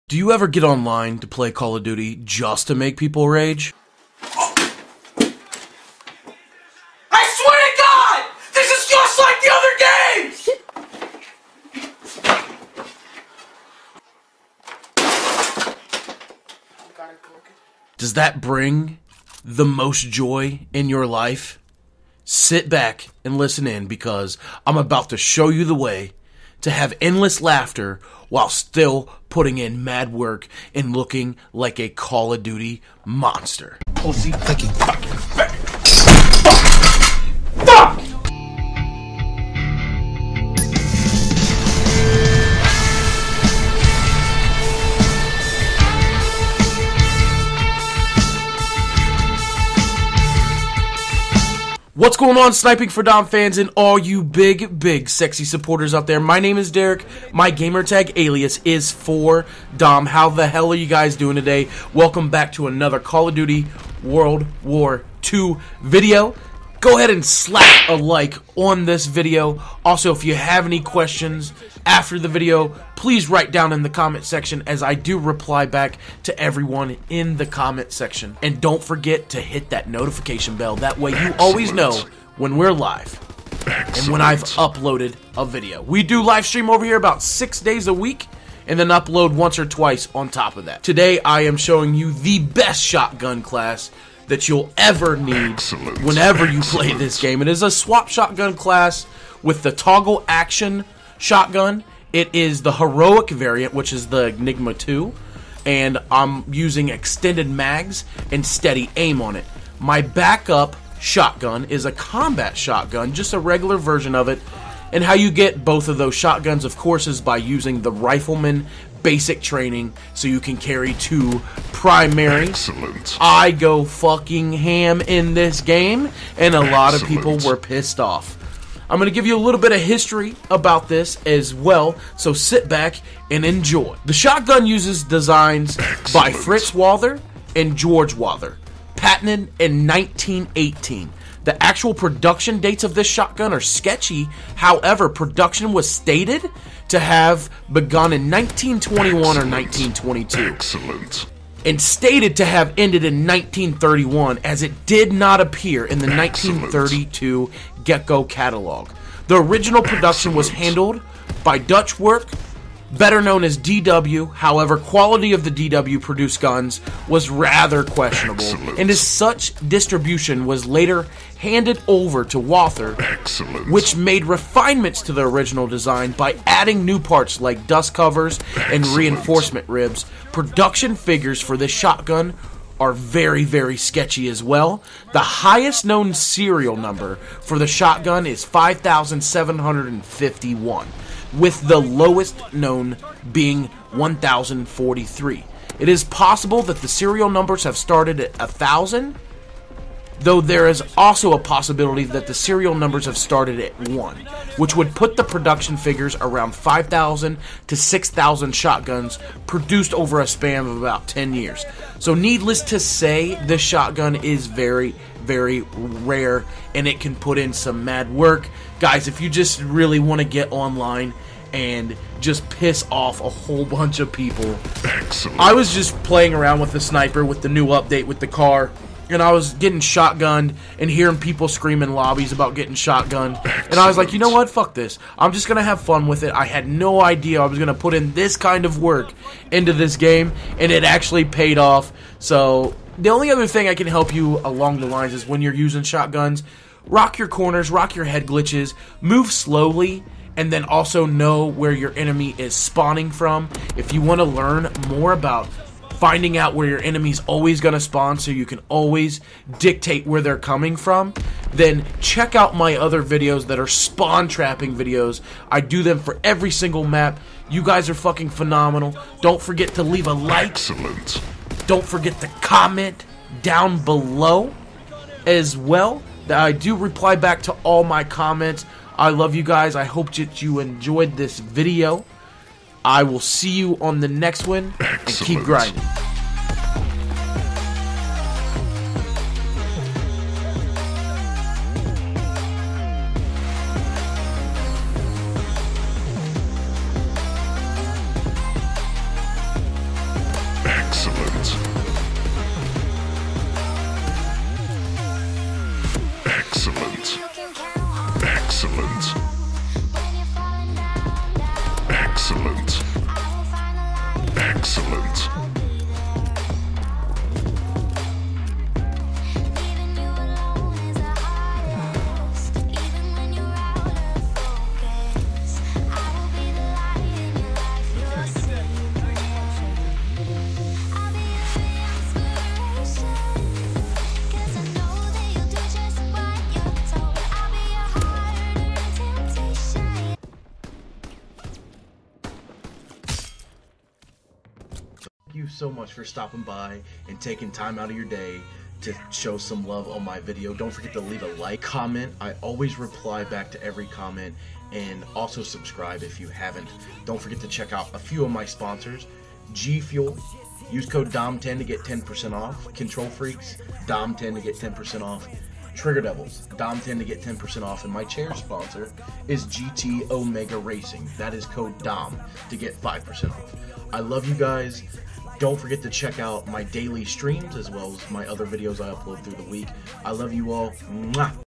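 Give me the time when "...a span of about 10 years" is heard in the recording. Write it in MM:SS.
03:30.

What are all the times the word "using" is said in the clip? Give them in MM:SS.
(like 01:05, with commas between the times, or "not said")
01:46, 01:57, 04:05.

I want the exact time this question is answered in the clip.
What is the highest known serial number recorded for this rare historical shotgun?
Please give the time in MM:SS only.
03:08.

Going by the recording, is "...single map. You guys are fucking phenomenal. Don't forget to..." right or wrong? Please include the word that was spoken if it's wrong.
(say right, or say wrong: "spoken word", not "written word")
right.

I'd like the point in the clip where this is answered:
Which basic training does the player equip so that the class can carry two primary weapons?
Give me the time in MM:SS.
01:57.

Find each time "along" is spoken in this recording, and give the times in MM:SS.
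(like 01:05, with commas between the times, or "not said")
04:04.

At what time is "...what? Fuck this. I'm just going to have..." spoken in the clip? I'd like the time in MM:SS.
03:54.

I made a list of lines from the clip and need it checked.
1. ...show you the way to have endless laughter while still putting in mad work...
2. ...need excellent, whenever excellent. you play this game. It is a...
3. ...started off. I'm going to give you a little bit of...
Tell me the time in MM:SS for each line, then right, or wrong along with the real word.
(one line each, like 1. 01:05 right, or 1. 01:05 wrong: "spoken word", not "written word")
1. 00:25 right
2. 01:35 right
3. 02:07 wrong: "pissed", not "started".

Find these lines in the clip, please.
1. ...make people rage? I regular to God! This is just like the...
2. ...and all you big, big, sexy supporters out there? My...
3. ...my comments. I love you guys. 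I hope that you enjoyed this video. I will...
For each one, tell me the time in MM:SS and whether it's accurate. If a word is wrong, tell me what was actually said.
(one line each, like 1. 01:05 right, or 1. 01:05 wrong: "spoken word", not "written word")
1. 00:02 wrong: "swear", not "regular"
2. 00:53 right
3. 04:37 right.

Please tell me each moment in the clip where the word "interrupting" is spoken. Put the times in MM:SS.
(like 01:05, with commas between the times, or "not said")
not said.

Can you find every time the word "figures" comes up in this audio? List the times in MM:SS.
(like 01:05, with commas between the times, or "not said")
03:00, 03:25.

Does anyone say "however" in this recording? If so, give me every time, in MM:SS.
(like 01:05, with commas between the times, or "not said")
02:24, 02:44.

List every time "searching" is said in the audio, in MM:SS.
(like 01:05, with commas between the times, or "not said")
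not said.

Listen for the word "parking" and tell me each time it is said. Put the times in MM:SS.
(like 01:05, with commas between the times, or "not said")
not said.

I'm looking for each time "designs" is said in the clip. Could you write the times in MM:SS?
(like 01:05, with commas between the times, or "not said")
02:15, 02:55.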